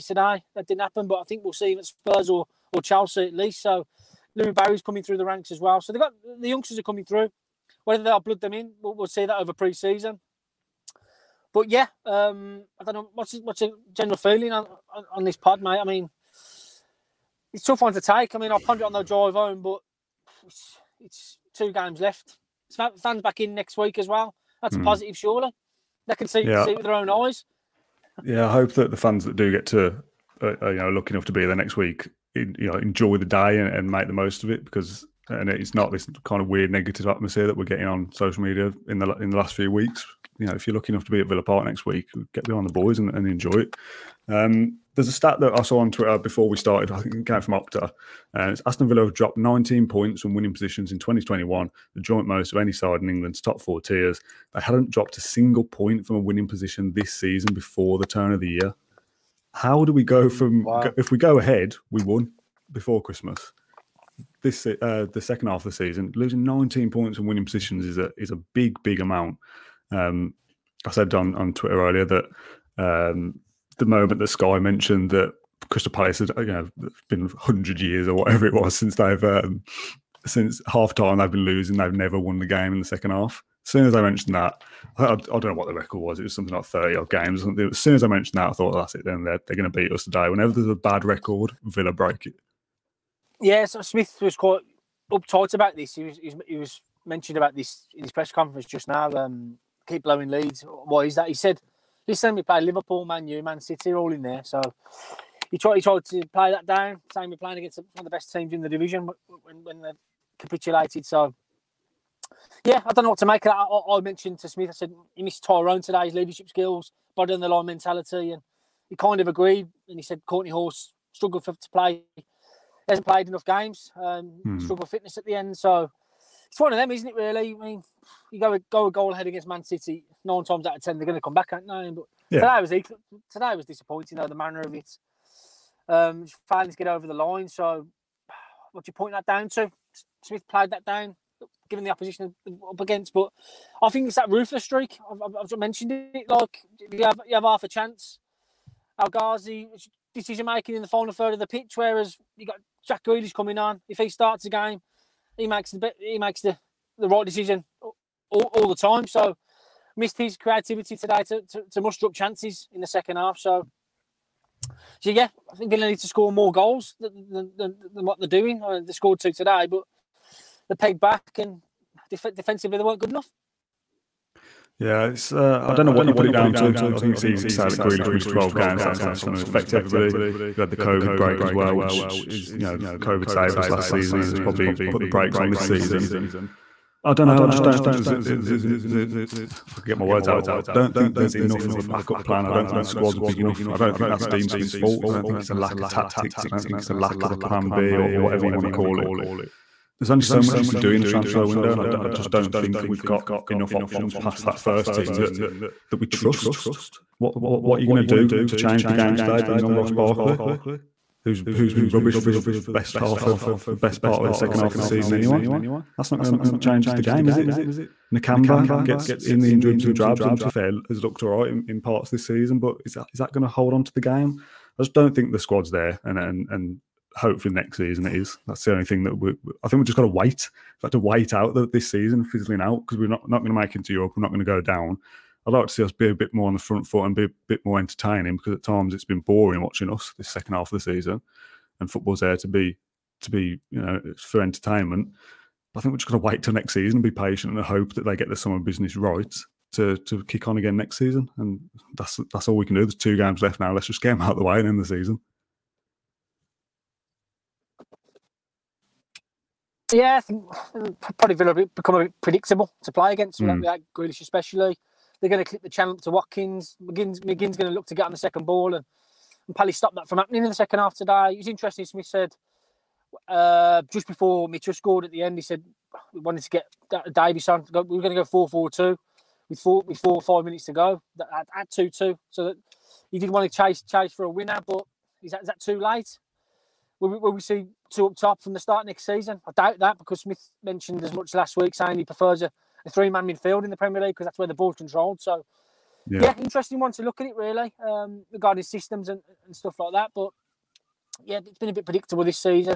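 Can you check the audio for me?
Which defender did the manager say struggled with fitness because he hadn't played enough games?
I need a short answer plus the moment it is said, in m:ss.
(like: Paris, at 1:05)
Kortney Hause, at 2:00.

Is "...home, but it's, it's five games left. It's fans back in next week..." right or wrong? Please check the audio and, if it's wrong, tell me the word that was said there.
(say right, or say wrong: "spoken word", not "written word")
wrong: "two", not "five".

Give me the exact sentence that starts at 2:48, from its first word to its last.
I uh, mean, they scored two today, but they pegged back and def- defensively they weren't good enough.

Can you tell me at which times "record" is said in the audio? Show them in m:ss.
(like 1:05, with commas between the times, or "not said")
1:25, 1:31.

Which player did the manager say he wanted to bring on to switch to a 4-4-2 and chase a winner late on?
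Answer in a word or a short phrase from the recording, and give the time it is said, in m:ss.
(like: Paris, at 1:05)
Davis, at 4:37.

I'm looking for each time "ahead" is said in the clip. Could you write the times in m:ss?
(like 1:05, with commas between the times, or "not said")
1:01, 2:09.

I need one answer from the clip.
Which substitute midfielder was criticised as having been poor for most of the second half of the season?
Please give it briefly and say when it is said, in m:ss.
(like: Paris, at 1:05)
Ross Barkley, at 3:29.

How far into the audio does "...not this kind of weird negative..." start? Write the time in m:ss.
0:35.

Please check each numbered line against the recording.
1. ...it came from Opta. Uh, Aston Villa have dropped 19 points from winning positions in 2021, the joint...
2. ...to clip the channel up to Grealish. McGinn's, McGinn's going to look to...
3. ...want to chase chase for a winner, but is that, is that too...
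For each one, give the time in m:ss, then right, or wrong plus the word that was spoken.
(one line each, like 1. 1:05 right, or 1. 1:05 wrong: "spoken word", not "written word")
1. 0:47 right
2. 4:25 wrong: "Watkins", not "Grealish"
3. 4:43 right.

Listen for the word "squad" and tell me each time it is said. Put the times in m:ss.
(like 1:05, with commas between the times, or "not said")
3:12, 3:45.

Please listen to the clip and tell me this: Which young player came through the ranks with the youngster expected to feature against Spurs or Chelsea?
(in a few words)
Louie Barry.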